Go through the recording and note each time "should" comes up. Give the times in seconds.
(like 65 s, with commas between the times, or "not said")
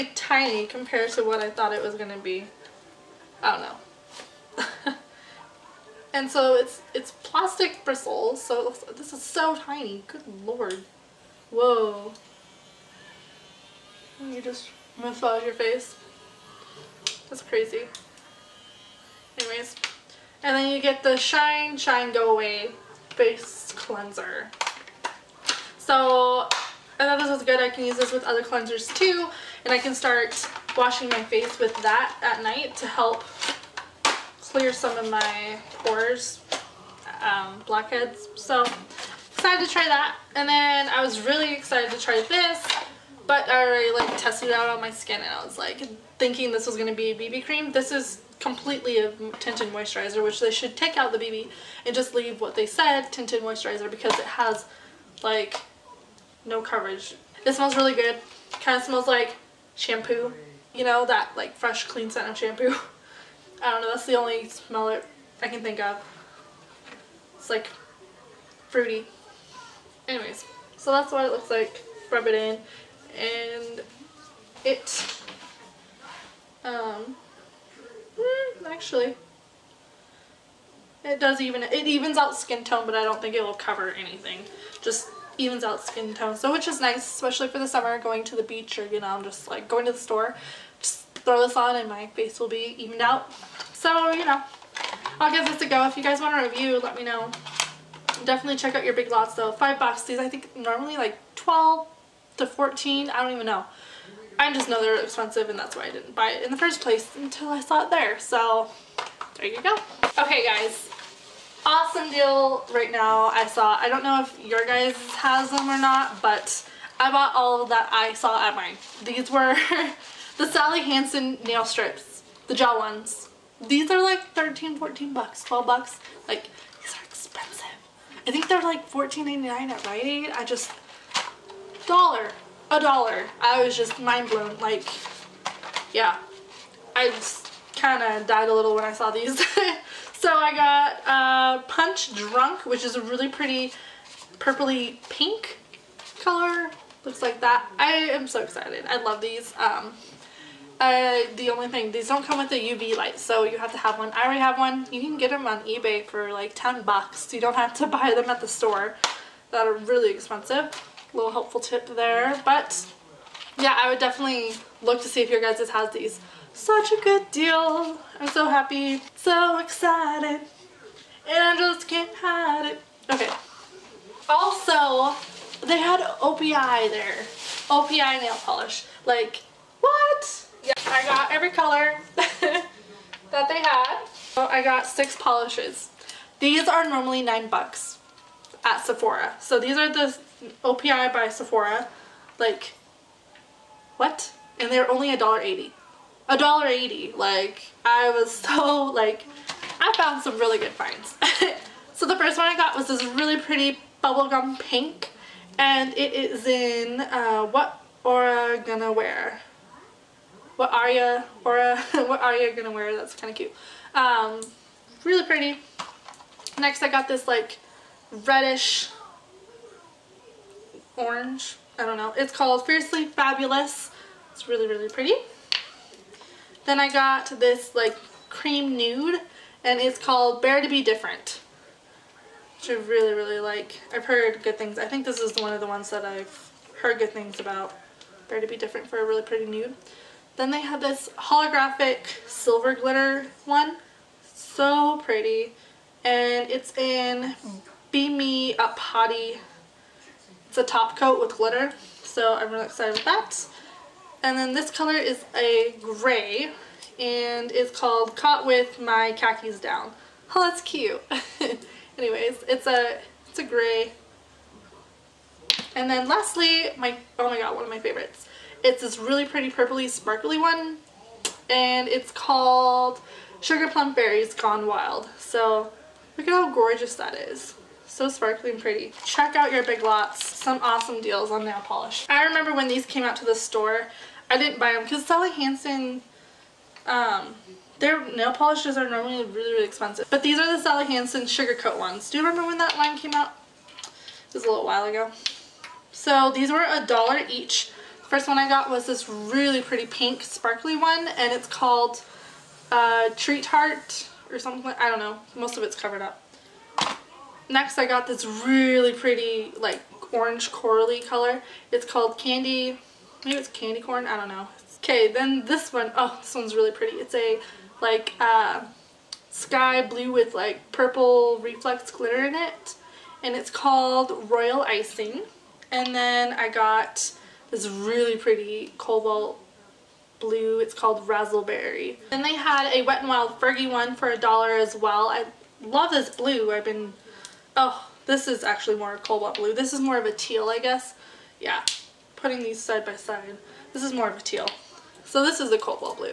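50 s.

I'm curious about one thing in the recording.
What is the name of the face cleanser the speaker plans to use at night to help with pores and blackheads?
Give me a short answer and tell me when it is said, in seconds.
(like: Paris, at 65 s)
Shine Shine Go Away, at 21 s.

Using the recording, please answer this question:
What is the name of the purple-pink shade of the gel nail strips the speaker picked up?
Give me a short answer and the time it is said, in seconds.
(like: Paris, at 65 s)
Punch Drunk, at 141 s.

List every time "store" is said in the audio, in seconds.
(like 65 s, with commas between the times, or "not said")
89 s, 158 s, 283 s.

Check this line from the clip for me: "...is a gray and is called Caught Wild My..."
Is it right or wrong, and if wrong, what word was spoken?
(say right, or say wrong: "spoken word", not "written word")
wrong: "With", not "Wild".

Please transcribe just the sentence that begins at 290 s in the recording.
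But these are the Sally Hansen Sugar Coat ones.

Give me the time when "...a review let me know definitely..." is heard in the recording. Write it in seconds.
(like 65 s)
96 s.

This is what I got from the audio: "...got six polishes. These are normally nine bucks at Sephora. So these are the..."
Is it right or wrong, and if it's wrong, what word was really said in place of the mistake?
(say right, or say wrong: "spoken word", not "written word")
right.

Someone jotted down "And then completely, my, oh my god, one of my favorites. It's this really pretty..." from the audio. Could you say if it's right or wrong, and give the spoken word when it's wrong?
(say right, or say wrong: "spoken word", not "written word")
wrong: "lastly", not "completely".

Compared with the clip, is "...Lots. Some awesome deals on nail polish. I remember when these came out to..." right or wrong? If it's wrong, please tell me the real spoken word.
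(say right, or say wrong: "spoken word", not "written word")
right.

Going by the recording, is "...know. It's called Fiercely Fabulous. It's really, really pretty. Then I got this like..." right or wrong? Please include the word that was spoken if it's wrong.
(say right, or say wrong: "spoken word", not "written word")
right.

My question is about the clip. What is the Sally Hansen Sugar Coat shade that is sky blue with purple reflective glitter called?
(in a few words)
Royal Icing.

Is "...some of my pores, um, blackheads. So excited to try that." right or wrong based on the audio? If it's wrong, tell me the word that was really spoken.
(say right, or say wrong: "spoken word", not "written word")
right.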